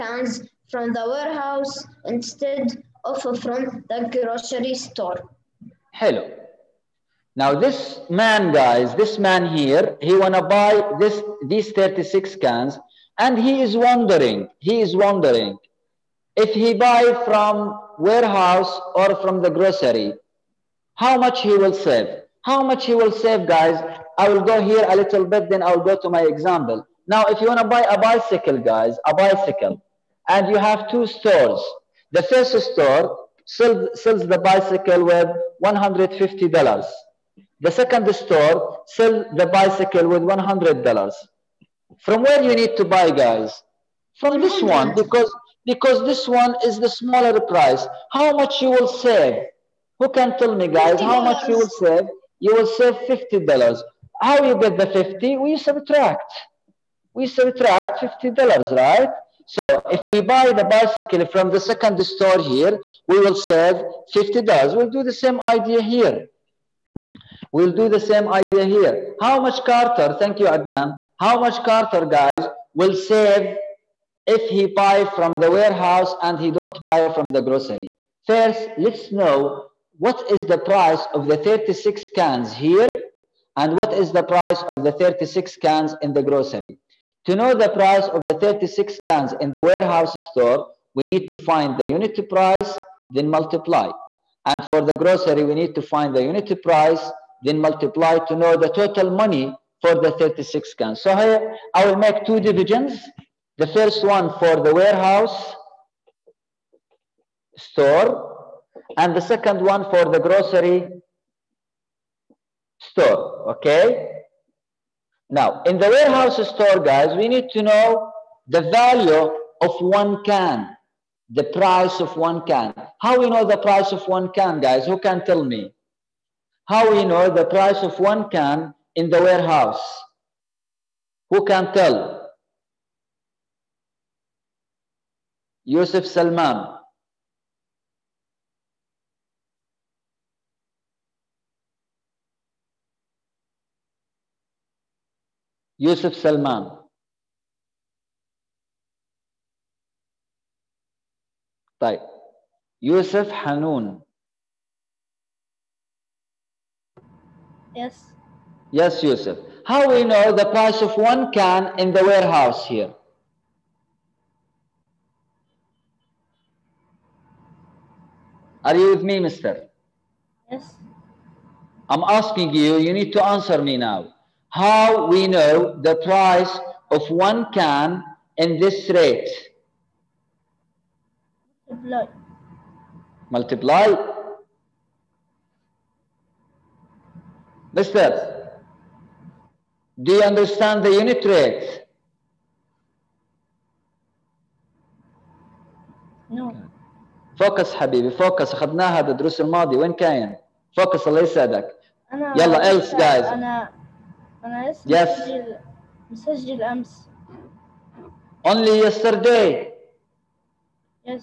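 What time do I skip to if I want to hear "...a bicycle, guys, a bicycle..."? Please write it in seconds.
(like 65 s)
27 s.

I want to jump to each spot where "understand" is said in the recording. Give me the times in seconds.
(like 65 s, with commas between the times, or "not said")
190 s.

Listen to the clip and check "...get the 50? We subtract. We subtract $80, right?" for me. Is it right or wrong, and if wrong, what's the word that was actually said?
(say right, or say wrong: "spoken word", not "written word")
wrong: "50", not "80".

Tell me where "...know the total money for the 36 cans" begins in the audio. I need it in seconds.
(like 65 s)
98 s.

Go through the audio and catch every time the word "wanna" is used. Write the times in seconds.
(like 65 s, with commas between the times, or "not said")
10 s, 27 s.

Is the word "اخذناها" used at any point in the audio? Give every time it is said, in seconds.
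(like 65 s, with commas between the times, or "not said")
198 s.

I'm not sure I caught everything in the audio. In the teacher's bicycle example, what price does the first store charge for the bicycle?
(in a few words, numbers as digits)
$150.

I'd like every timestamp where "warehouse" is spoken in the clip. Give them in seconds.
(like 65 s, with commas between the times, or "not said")
1 s, 17 s, 75 s, 89 s, 104 s, 115 s, 129 s, 162 s.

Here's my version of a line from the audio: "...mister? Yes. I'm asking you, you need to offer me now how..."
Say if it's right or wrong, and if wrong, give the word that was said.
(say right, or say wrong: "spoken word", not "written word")
wrong: "answer", not "offer".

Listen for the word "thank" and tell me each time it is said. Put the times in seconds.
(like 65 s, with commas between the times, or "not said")
70 s.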